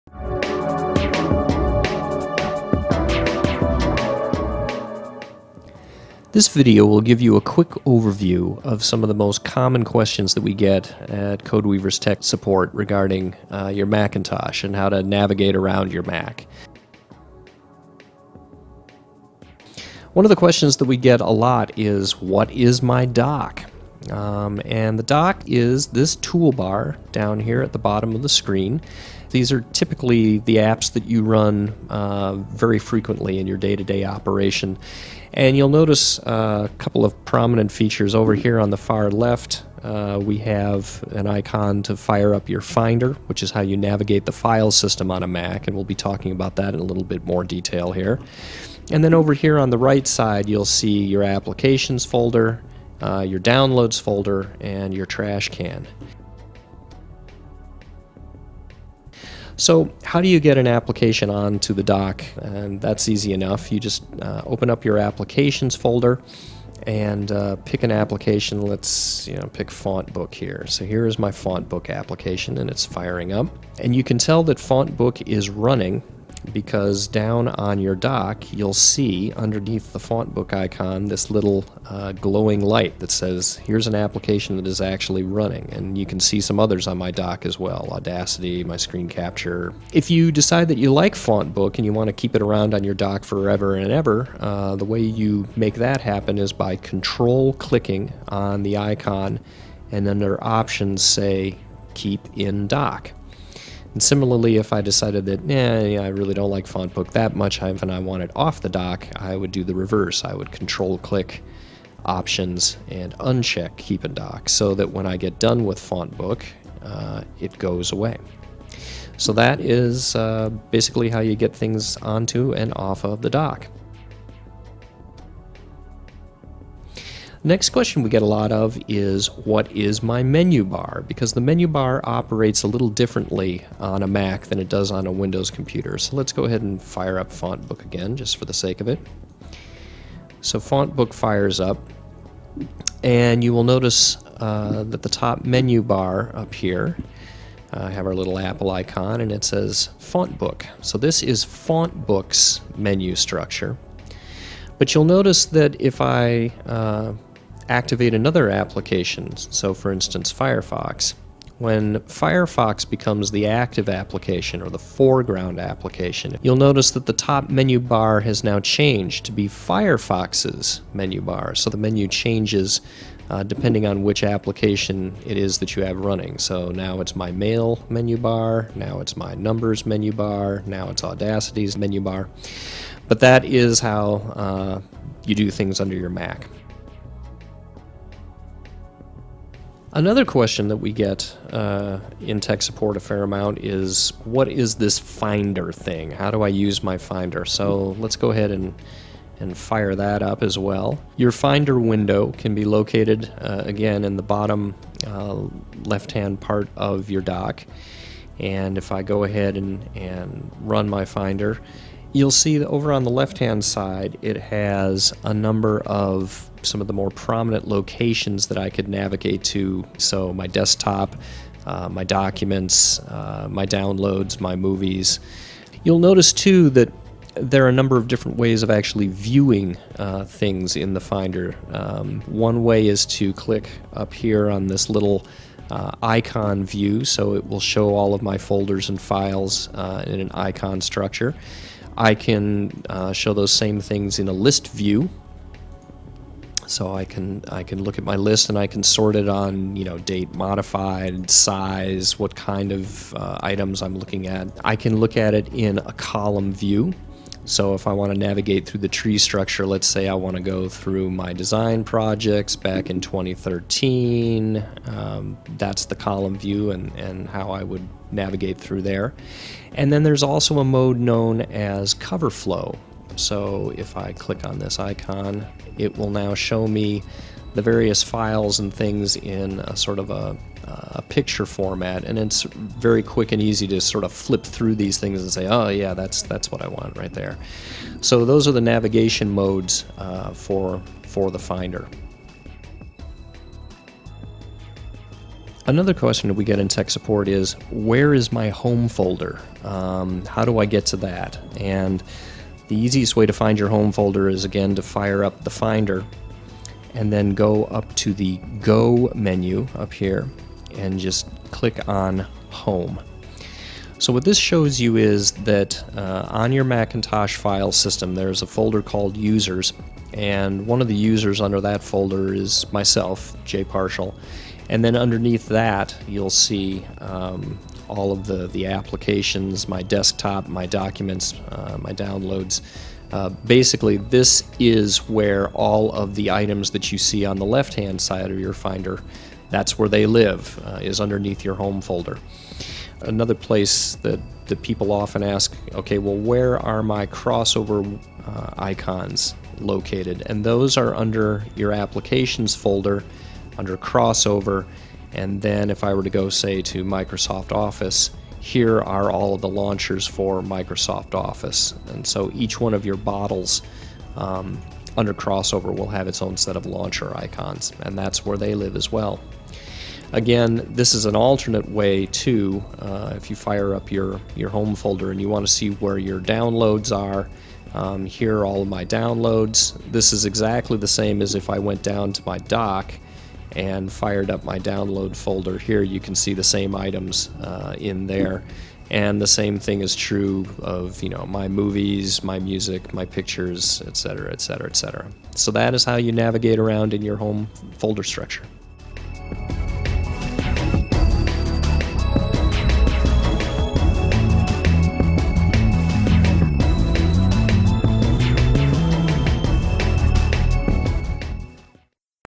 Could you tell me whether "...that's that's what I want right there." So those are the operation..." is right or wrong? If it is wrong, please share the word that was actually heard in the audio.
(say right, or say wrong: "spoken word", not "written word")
wrong: "navigation", not "operation".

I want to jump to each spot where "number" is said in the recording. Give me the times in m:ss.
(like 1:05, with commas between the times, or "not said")
2:59, 3:35, 3:47.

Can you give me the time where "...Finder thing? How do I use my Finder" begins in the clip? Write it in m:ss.
3:14.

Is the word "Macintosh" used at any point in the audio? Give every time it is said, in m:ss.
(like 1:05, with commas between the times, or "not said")
0:13, 5:16.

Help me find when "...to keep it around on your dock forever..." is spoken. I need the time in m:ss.
1:32.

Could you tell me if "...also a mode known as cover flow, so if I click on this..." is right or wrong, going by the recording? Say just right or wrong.
right.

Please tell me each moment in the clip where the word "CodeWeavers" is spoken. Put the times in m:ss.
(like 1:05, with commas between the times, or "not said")
0:11.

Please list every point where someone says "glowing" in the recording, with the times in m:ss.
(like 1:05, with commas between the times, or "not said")
1:22.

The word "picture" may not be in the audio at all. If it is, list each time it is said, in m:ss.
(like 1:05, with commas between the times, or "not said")
4:41, 6:33.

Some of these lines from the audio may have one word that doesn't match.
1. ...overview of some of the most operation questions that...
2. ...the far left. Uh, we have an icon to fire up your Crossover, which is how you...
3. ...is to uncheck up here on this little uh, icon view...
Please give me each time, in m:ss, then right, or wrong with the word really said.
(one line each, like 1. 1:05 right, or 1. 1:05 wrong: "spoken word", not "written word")
1. 0:07 wrong: "common", not "operation"
2. 0:38 wrong: "Finder", not "Crossover"
3. 3:52 wrong: "click", not "uncheck".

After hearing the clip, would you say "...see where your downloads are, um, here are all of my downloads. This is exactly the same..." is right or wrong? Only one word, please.
right.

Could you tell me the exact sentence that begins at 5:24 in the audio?
And then underneath that you'll see um, all of the, the applications, my desktop, my documents, uh, my downloads.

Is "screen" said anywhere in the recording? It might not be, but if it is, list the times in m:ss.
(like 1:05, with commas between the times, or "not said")
0:28, 1:28.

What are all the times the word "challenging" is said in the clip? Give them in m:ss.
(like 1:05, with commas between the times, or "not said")
not said.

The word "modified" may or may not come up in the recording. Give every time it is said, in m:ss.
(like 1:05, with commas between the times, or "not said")
4:10.